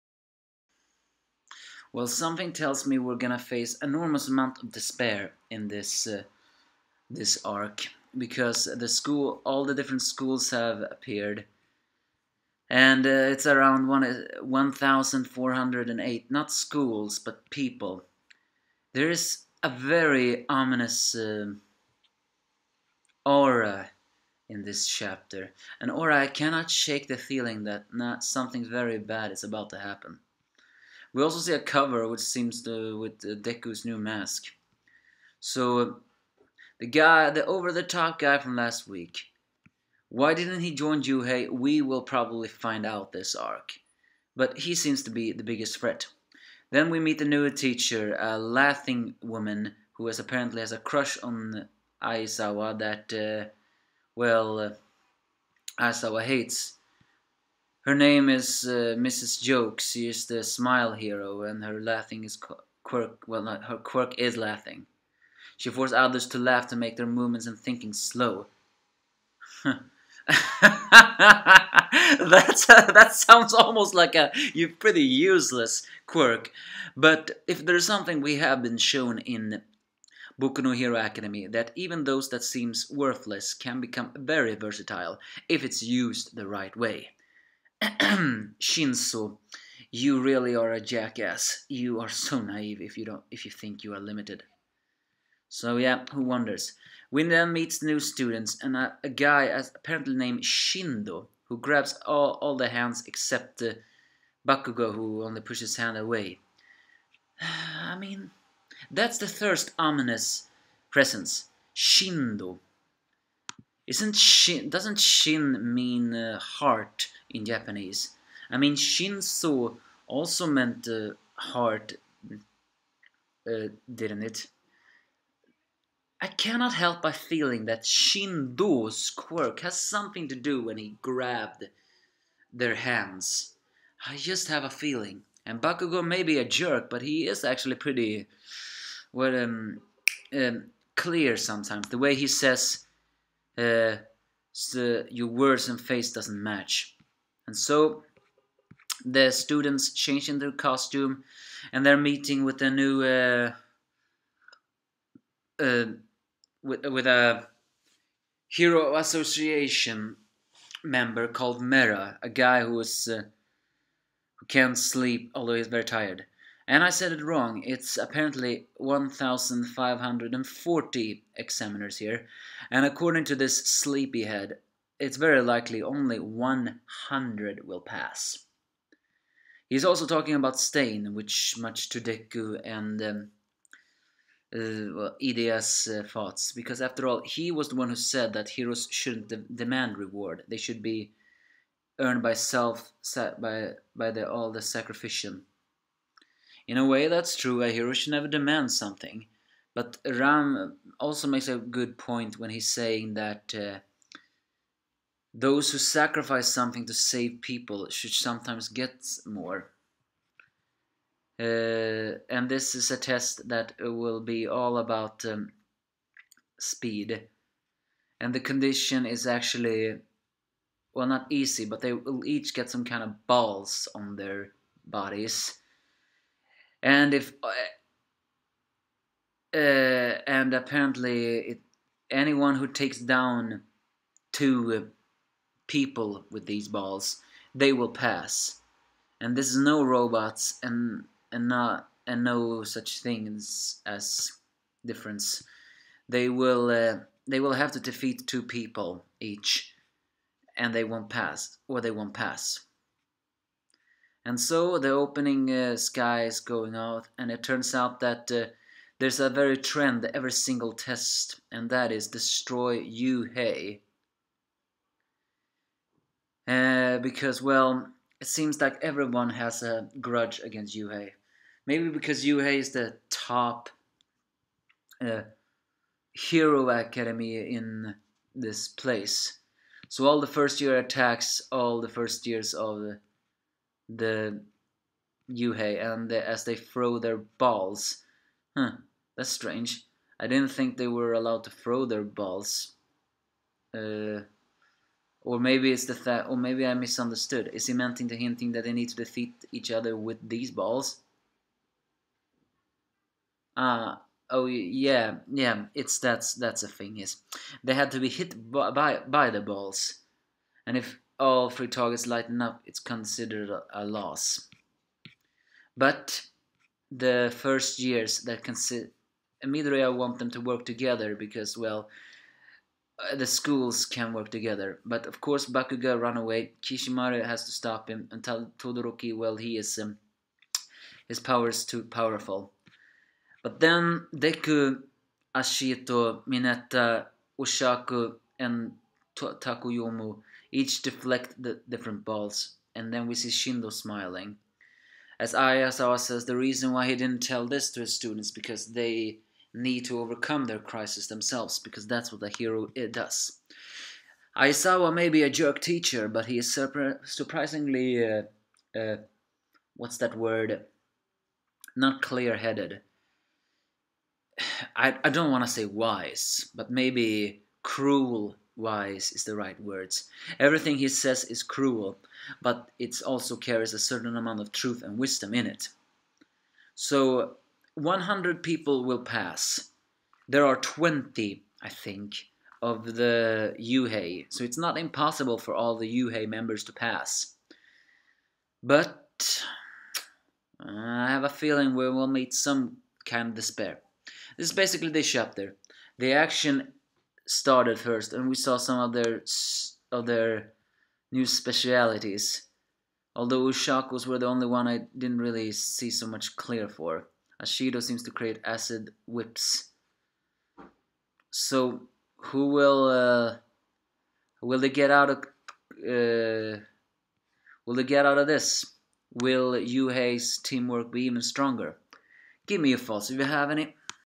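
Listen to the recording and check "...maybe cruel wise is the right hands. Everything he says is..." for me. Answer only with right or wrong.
wrong.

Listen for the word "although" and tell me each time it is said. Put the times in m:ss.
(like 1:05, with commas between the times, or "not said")
2:45, 6:43.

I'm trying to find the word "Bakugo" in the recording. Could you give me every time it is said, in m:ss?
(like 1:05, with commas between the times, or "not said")
1:44, 2:15, 5:25.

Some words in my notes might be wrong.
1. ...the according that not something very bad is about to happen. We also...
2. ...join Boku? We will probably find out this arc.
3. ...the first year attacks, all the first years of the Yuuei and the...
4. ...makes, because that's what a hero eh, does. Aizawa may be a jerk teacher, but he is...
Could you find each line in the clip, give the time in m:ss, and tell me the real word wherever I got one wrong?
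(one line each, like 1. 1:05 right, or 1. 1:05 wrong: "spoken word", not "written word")
1. 0:27 wrong: "feeling", not "according"
2. 0:40 wrong: "Yuuei", not "Boku"
3. 4:40 right
4. 5:51 wrong: "themselves", not "makes".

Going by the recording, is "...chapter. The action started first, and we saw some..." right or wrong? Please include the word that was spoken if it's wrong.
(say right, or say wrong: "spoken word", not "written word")
right.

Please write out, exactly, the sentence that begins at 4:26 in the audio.
Uh, because, well, it seems like everyone has a grudge against Yuuei.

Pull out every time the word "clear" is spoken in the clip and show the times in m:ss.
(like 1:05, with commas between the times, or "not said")
2:20, 6:02, 6:46.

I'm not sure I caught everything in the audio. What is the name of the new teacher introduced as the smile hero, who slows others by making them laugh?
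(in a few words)
Mrs. Joke.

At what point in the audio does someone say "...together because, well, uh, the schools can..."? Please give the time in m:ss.
5:20.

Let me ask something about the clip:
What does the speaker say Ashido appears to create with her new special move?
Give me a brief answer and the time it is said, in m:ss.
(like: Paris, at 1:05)
Acid whips, at 6:48.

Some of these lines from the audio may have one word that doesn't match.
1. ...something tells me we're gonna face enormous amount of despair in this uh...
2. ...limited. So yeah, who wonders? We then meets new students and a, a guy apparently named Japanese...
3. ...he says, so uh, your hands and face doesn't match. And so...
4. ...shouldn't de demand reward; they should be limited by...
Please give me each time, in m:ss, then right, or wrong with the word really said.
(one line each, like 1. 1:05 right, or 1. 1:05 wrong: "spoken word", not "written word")
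1. 0:02 right
2. 1:33 wrong: "Shindo", not "Japanese"
3. 2:22 wrong: "words", not "hands"
4. 3:08 wrong: "earned", not "limited".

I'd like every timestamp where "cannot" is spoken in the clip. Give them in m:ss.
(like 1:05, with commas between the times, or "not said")
0:26, 2:06.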